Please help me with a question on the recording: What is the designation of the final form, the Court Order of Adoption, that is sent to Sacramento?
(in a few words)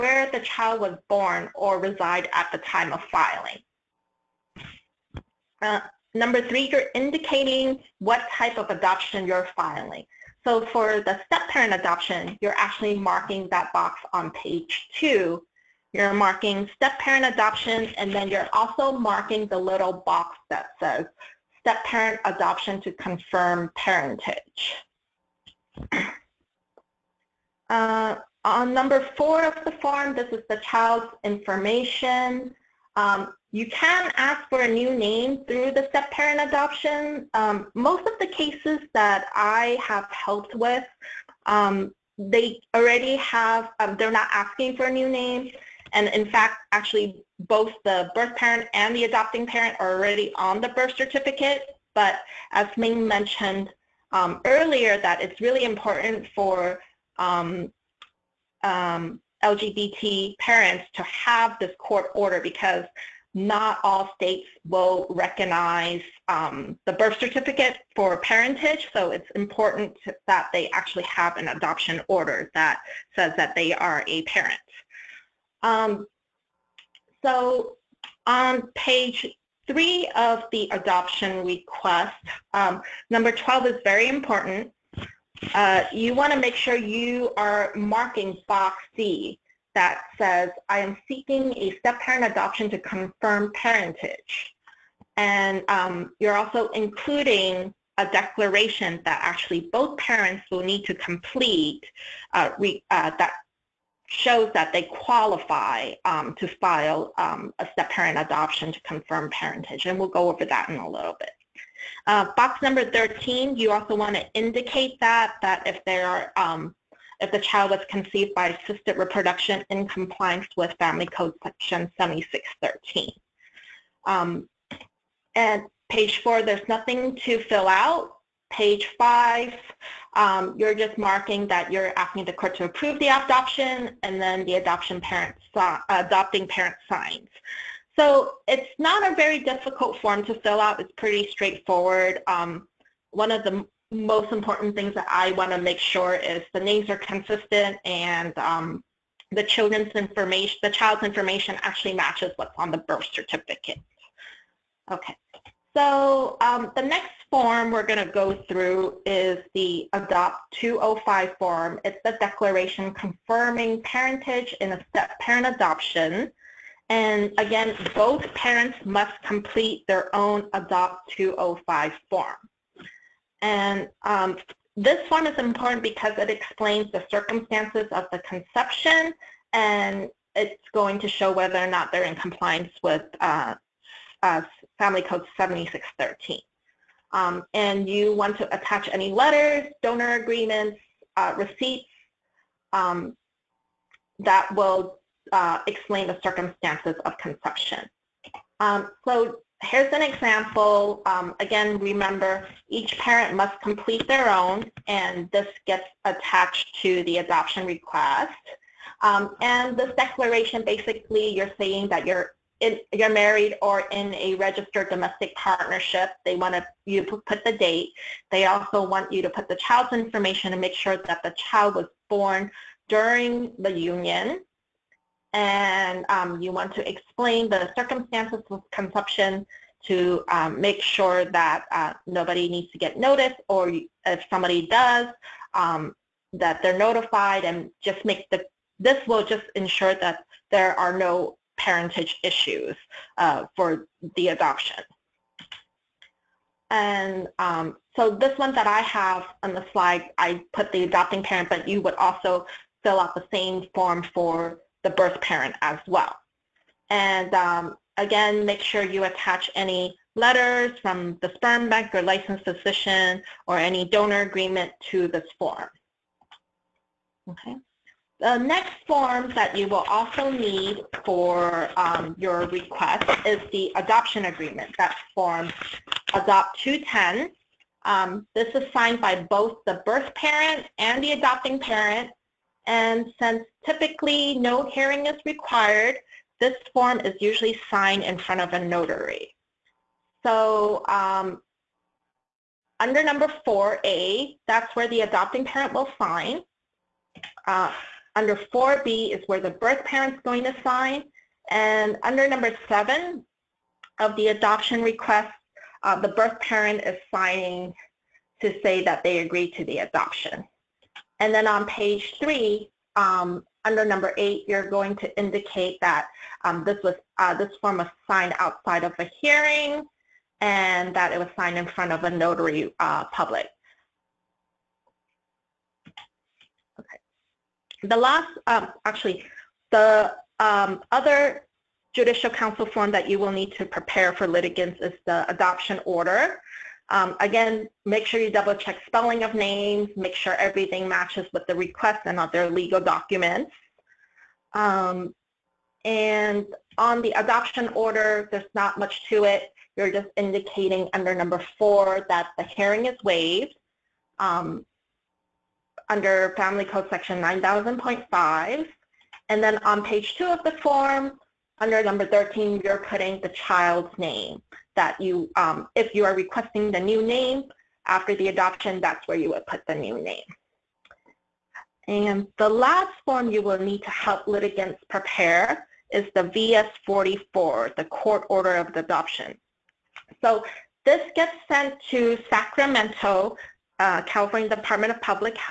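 VS-44.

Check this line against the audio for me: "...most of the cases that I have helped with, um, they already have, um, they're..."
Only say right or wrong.
right.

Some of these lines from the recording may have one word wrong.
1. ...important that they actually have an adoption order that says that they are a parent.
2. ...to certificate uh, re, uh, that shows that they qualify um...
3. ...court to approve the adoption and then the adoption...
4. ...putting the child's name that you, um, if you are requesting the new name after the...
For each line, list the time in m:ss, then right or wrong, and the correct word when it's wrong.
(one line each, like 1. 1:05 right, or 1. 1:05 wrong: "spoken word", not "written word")
1. 1:09 right
2. 1:40 wrong: "complete", not "certificate"
3. 2:12 right
4. 6:02 right.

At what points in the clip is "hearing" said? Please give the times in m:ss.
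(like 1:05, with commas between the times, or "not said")
4:44, 5:19, 5:52.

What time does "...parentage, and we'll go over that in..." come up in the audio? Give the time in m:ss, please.
1:49.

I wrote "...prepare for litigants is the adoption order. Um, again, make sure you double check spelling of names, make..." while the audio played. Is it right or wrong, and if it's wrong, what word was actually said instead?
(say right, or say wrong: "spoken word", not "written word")
right.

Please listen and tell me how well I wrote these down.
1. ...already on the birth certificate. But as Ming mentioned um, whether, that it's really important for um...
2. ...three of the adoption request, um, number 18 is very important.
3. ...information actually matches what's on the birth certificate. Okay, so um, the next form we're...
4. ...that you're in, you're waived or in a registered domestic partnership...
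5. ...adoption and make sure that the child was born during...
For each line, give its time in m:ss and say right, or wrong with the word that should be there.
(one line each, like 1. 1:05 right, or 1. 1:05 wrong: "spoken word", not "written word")
1. 0:49 wrong: "earlier", not "whether"
2. 1:19 wrong: "12", not "18"
3. 2:31 right
4. 3:31 wrong: "married", not "waived"
5. 3:39 wrong: "information", not "adoption".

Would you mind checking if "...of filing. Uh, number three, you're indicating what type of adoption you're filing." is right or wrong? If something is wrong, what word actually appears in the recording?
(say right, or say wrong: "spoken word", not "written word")
right.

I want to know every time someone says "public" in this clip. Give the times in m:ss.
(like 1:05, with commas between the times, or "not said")
5:23, 6:25.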